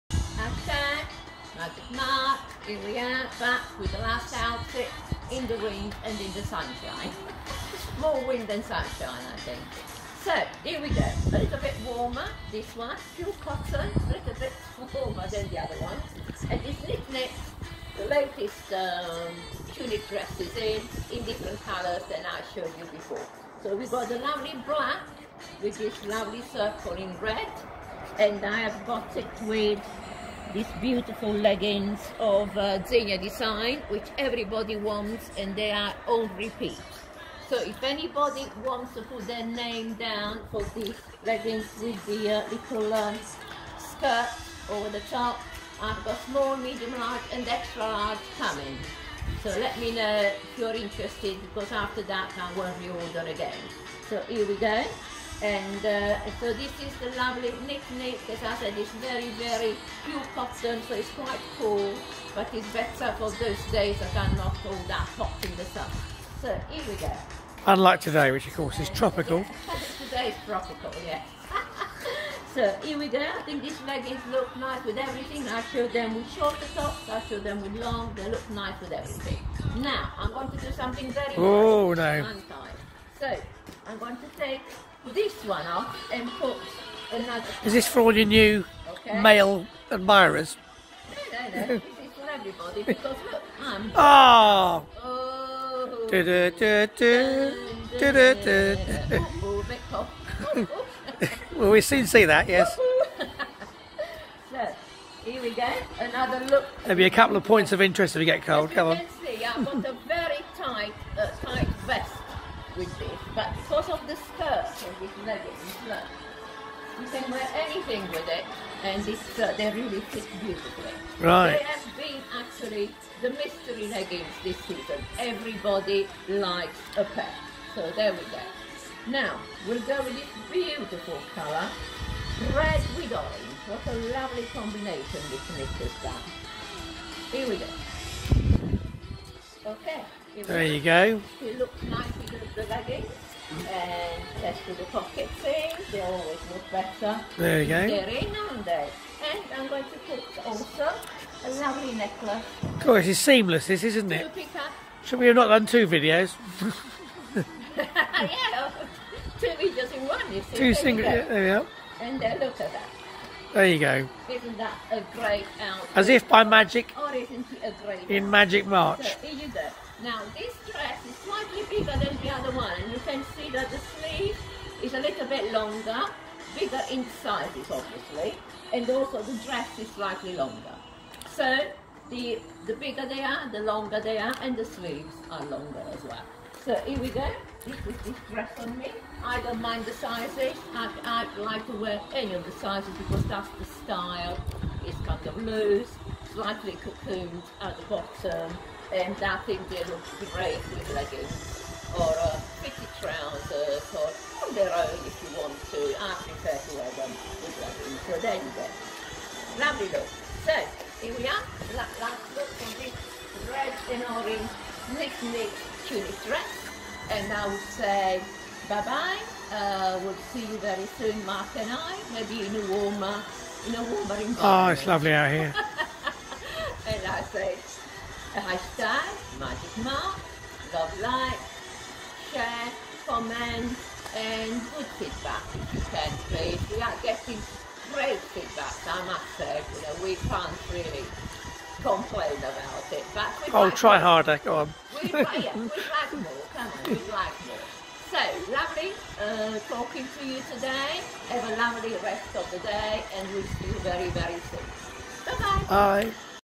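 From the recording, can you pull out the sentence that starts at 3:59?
You know, we can't really complain about it.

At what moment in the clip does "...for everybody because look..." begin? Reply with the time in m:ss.
1:32.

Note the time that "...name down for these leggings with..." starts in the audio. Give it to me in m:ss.
0:39.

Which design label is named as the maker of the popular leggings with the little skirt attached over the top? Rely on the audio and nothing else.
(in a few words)
Xenia.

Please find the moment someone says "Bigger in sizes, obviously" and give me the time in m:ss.
2:56.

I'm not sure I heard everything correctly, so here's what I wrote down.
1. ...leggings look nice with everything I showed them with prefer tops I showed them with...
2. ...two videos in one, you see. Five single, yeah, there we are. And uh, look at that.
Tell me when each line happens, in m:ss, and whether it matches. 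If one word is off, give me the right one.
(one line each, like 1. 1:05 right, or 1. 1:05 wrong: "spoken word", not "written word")
1. 1:13 wrong: "shorter", not "prefer"
2. 2:39 wrong: "Two", not "Five".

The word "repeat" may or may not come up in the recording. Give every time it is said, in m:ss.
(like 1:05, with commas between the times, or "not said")
0:36.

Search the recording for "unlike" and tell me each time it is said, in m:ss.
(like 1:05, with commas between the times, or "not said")
1:07.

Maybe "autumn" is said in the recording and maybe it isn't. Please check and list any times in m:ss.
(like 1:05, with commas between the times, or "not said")
not said.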